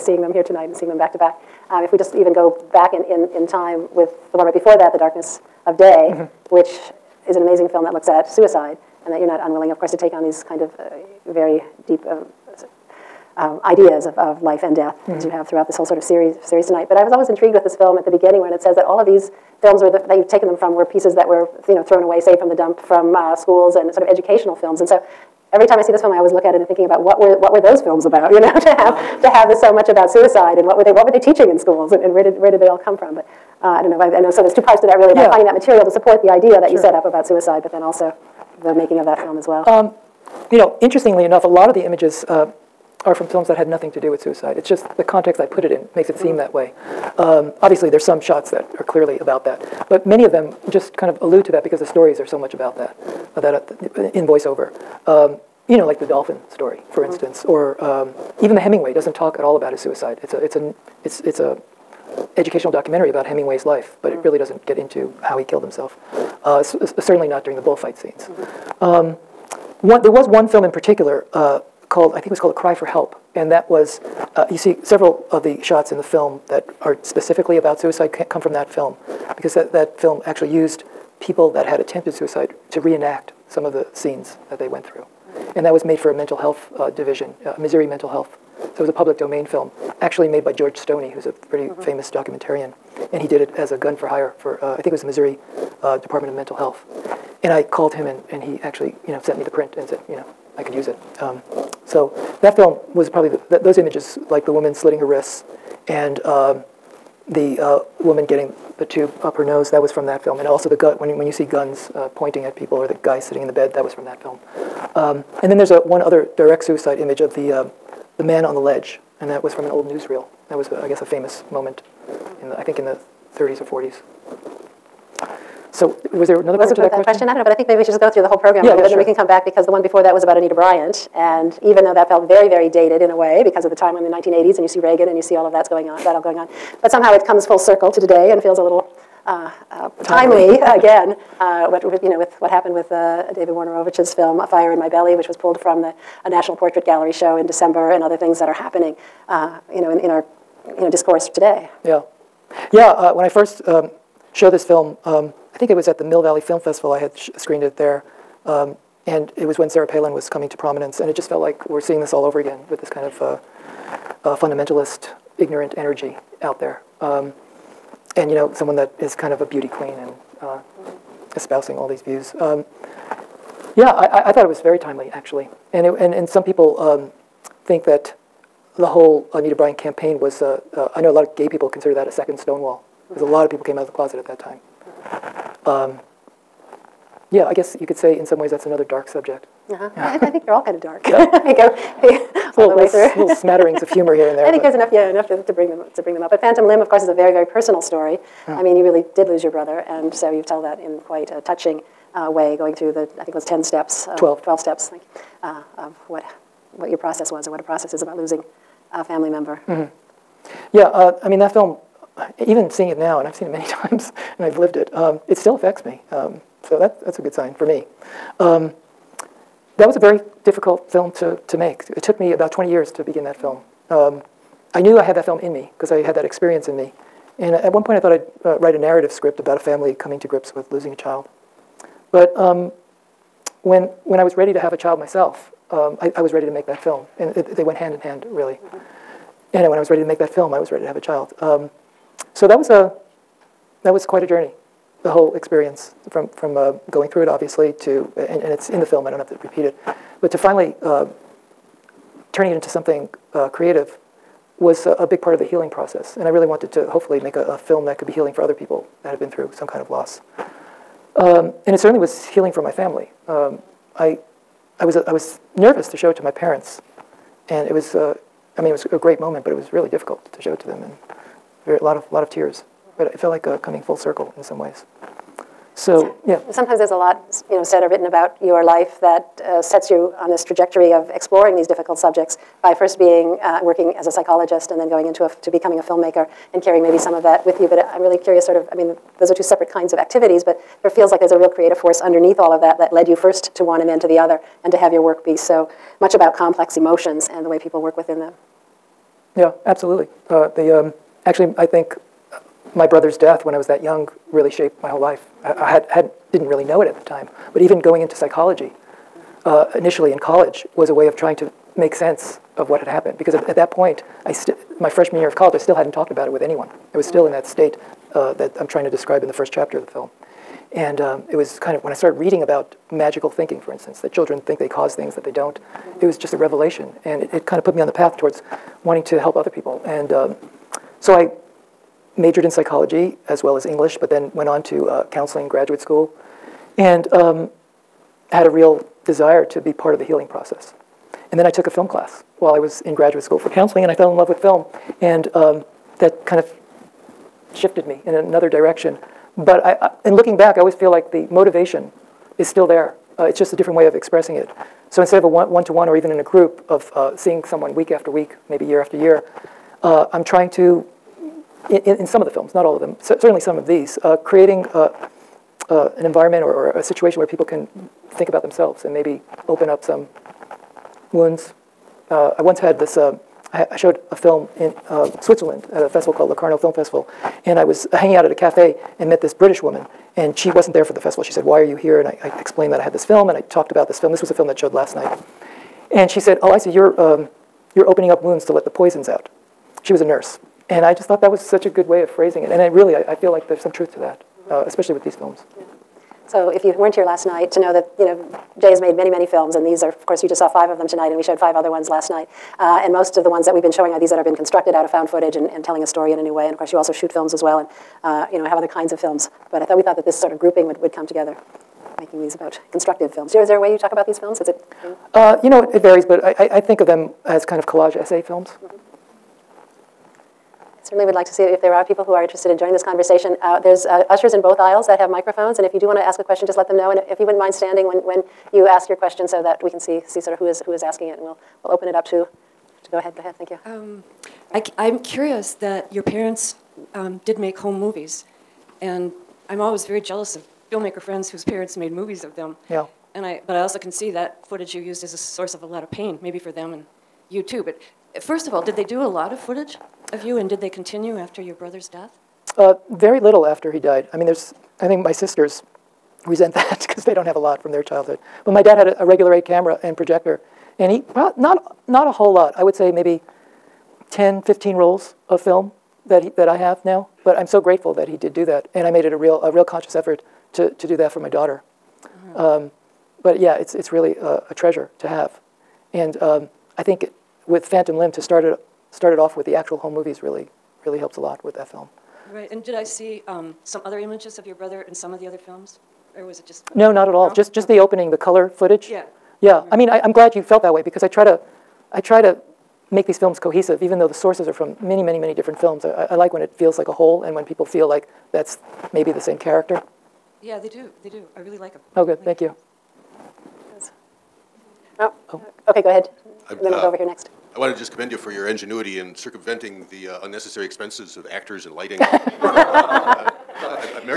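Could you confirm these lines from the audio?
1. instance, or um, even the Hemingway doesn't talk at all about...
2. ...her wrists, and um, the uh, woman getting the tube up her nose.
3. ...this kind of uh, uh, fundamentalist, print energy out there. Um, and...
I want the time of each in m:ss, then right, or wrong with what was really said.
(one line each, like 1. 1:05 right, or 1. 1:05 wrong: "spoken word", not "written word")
1. 0:57 right
2. 1:44 right
3. 2:42 wrong: "ignorant", not "print".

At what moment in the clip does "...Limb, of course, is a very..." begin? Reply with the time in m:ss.
3:16.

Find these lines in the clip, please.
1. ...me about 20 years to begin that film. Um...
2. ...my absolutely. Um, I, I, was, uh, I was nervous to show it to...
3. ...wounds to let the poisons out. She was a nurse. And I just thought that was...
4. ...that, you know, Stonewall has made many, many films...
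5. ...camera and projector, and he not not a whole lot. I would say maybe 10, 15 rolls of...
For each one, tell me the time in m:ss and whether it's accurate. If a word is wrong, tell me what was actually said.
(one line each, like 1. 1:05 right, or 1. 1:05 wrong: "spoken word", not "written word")
1. 3:42 right
2. 4:22 wrong: "family", not "absolutely"
3. 6:28 right
4. 6:37 wrong: "Jay", not "Stonewall"
5. 7:39 right.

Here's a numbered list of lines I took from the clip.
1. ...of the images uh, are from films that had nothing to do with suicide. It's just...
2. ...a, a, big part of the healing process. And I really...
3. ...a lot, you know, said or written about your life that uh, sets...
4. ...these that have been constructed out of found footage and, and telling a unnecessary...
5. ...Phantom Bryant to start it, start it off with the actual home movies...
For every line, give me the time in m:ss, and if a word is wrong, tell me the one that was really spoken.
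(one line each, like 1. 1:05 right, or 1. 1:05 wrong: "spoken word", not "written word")
1. 0:41 right
2. 4:14 right
3. 4:36 right
4. 6:43 wrong: "story", not "unnecessary"
5. 7:57 wrong: "Limb", not "Bryant".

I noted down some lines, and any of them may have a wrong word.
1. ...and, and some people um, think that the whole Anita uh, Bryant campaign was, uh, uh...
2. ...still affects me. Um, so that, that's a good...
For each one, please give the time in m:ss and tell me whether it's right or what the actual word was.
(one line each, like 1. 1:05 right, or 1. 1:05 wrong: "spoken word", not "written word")
1. 2:55 right
2. 3:35 right.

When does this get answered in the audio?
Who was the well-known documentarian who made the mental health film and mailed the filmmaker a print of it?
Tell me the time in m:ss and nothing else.
1:30.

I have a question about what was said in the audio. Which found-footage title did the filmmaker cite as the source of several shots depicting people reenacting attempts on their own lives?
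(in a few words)
A Cry for Help.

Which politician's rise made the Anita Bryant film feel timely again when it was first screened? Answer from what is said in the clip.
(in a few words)
Sarah Palin.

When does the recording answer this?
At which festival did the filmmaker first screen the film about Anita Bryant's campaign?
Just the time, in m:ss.
2:36.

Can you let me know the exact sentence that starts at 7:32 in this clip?
Uh, very little after he died.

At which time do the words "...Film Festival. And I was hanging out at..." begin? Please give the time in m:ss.
6:16.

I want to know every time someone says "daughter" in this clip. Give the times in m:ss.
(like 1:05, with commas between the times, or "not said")
7:51.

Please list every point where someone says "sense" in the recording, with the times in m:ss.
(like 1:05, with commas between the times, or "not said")
5:11.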